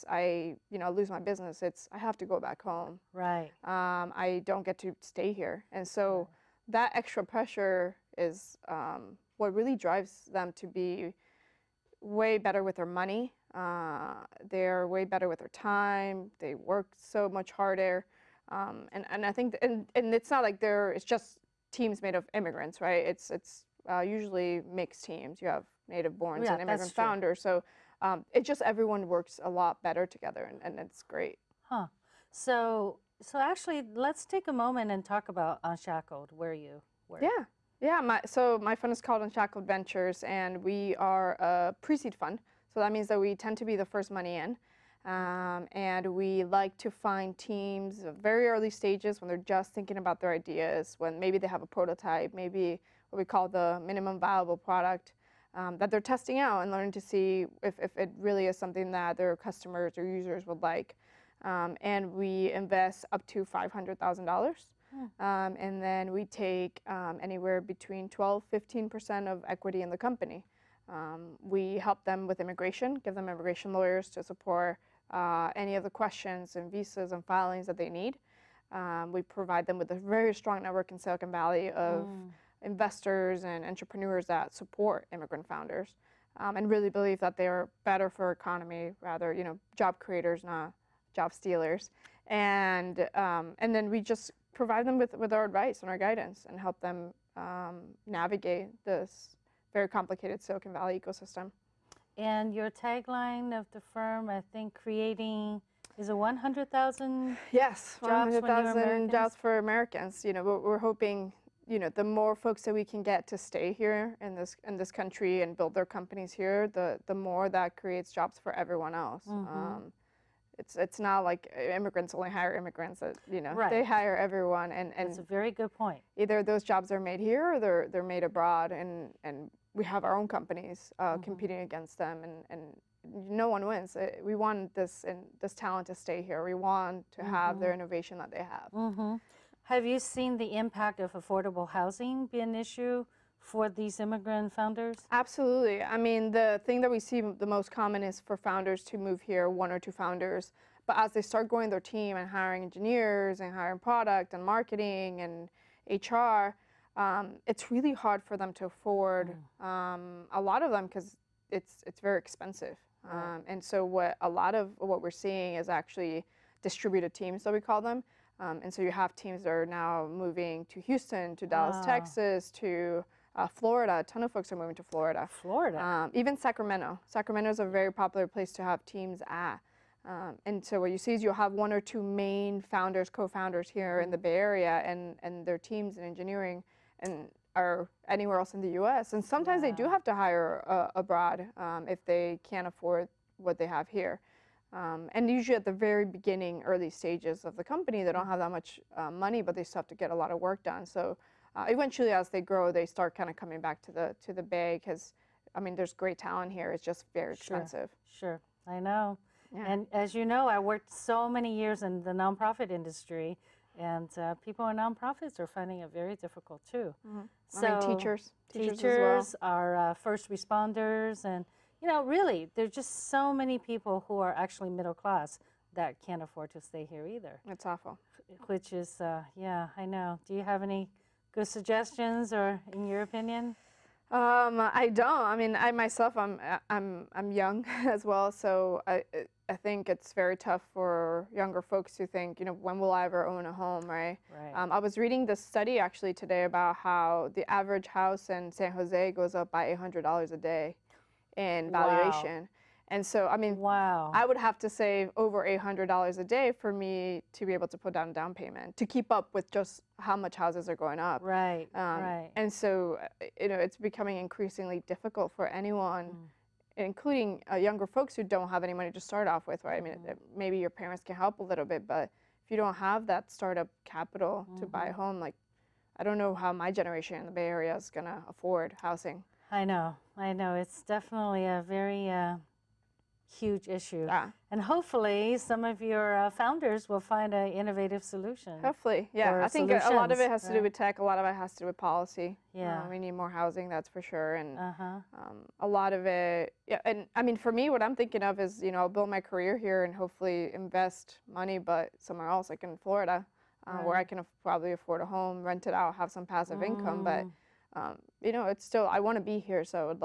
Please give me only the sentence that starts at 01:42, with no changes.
And your tagline of the firm, I think, creating is a 100,000 yes 100,000 jobs for Americans.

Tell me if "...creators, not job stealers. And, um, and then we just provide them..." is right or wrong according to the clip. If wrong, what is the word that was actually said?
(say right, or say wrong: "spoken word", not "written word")
right.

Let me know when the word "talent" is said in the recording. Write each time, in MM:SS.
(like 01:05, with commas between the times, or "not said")
02:15, 03:26.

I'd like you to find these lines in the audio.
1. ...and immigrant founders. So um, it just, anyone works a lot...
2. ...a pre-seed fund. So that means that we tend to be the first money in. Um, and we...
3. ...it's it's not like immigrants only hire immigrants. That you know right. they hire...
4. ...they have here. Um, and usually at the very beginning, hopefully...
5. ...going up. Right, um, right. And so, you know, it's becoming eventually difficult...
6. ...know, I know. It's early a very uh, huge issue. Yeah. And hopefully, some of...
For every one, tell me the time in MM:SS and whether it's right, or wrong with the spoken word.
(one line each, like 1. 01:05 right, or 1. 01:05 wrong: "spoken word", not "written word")
1. 00:26 wrong: "everyone", not "anyone"
2. 00:41 right
3. 02:00 right
4. 03:13 wrong: "early", not "hopefully"
5. 04:20 wrong: "increasingly", not "eventually"
6. 04:39 wrong: "definitely", not "early".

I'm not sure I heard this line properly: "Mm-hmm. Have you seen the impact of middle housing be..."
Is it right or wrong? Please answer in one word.
wrong.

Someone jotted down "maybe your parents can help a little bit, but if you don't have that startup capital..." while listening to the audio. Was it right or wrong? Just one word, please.
right.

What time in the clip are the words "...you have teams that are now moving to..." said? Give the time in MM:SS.
02:48.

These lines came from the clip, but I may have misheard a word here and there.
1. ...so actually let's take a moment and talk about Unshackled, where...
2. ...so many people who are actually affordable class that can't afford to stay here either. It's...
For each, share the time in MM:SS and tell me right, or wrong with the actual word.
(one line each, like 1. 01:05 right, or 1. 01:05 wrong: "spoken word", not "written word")
1. 00:33 right
2. 03:43 wrong: "middle", not "affordable".